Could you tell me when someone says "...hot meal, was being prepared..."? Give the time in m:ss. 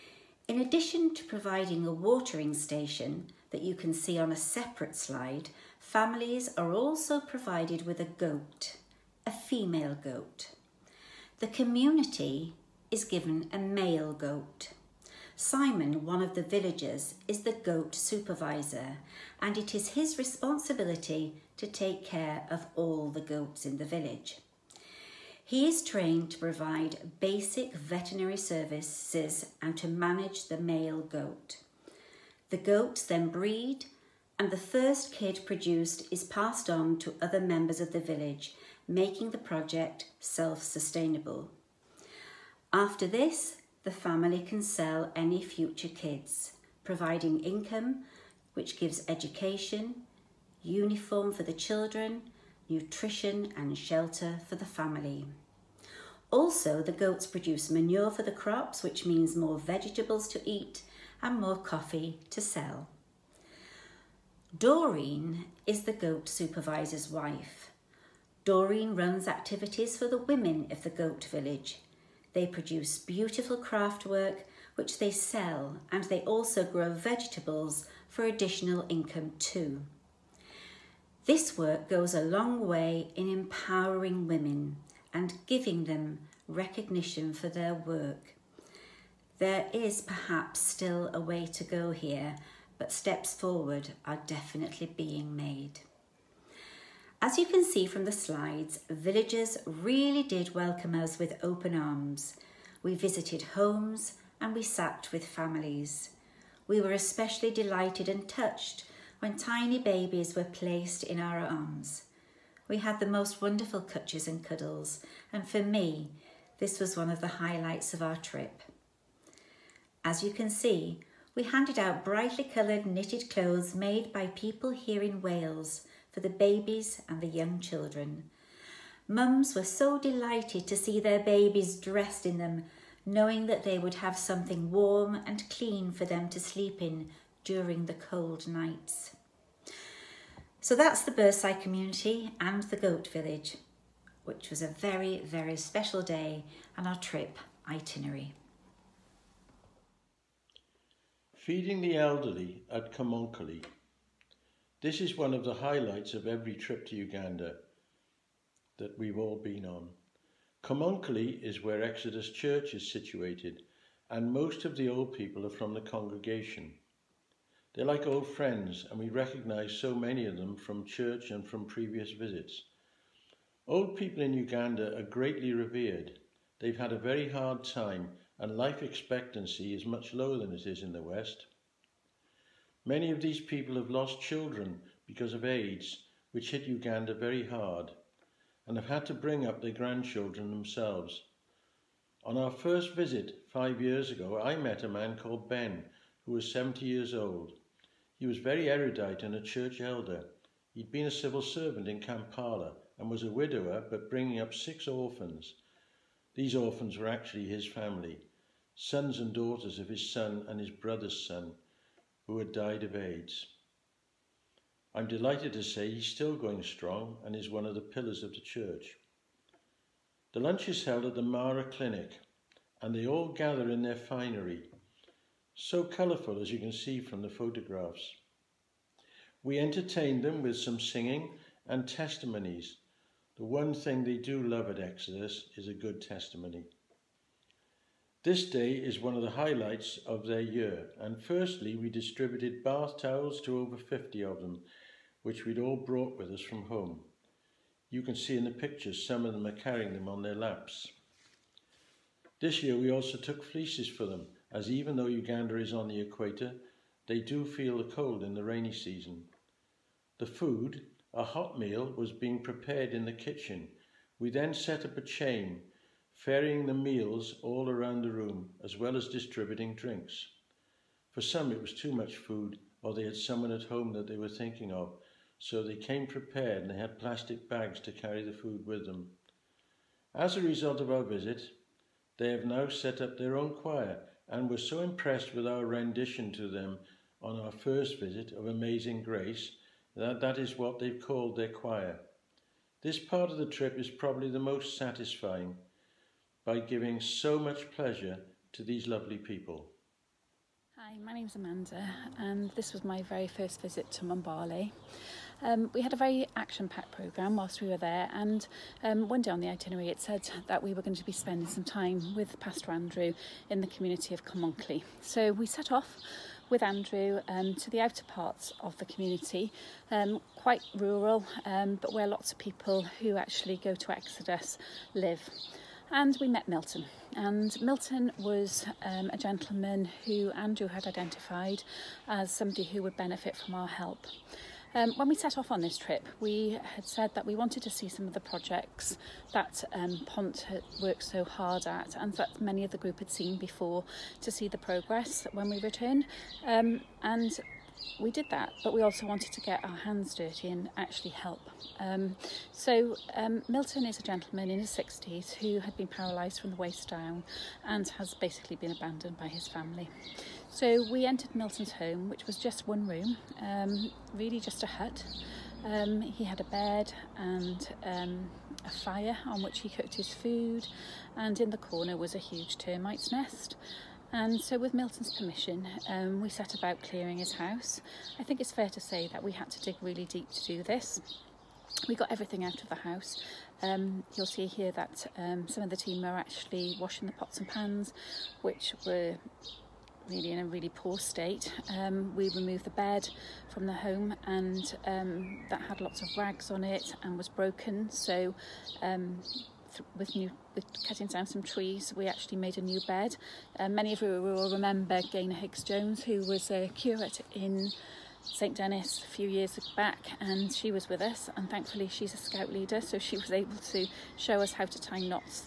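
4:21.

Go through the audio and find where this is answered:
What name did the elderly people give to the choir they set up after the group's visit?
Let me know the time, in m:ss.
4:48.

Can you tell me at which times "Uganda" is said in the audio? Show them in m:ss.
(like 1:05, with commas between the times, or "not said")
2:36, 2:54, 3:06, 4:15.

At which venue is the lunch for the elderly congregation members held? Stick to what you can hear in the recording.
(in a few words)
Mara Clinic.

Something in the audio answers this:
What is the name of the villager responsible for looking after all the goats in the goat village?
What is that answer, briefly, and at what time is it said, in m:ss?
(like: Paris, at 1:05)
Simon, at 0:15.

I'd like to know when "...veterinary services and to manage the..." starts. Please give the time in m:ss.
0:27.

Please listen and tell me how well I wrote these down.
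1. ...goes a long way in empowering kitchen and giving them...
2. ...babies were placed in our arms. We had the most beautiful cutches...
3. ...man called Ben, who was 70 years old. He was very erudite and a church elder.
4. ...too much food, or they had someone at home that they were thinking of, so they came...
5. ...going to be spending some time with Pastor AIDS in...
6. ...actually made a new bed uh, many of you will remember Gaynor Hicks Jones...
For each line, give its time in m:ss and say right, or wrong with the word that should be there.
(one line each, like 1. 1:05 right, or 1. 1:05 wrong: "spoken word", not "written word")
1. 1:21 wrong: "women", not "kitchen"
2. 1:49 wrong: "wonderful", not "beautiful"
3. 3:14 right
4. 4:31 right
5. 5:10 wrong: "Andrew", not "AIDS"
6. 6:42 right.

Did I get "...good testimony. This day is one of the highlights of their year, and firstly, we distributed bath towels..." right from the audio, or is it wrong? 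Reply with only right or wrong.
right.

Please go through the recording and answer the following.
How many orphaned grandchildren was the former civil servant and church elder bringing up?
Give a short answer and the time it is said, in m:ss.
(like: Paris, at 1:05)
6, at 3:24.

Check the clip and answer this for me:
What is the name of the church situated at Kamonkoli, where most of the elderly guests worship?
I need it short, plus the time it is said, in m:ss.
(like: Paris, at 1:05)
Exodus Church, at 2:41.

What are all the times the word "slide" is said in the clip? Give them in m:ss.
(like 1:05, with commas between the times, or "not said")
0:04, 1:38.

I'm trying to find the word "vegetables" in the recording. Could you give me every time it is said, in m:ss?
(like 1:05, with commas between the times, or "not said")
0:59, 1:16.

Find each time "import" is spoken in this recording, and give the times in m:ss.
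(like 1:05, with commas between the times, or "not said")
not said.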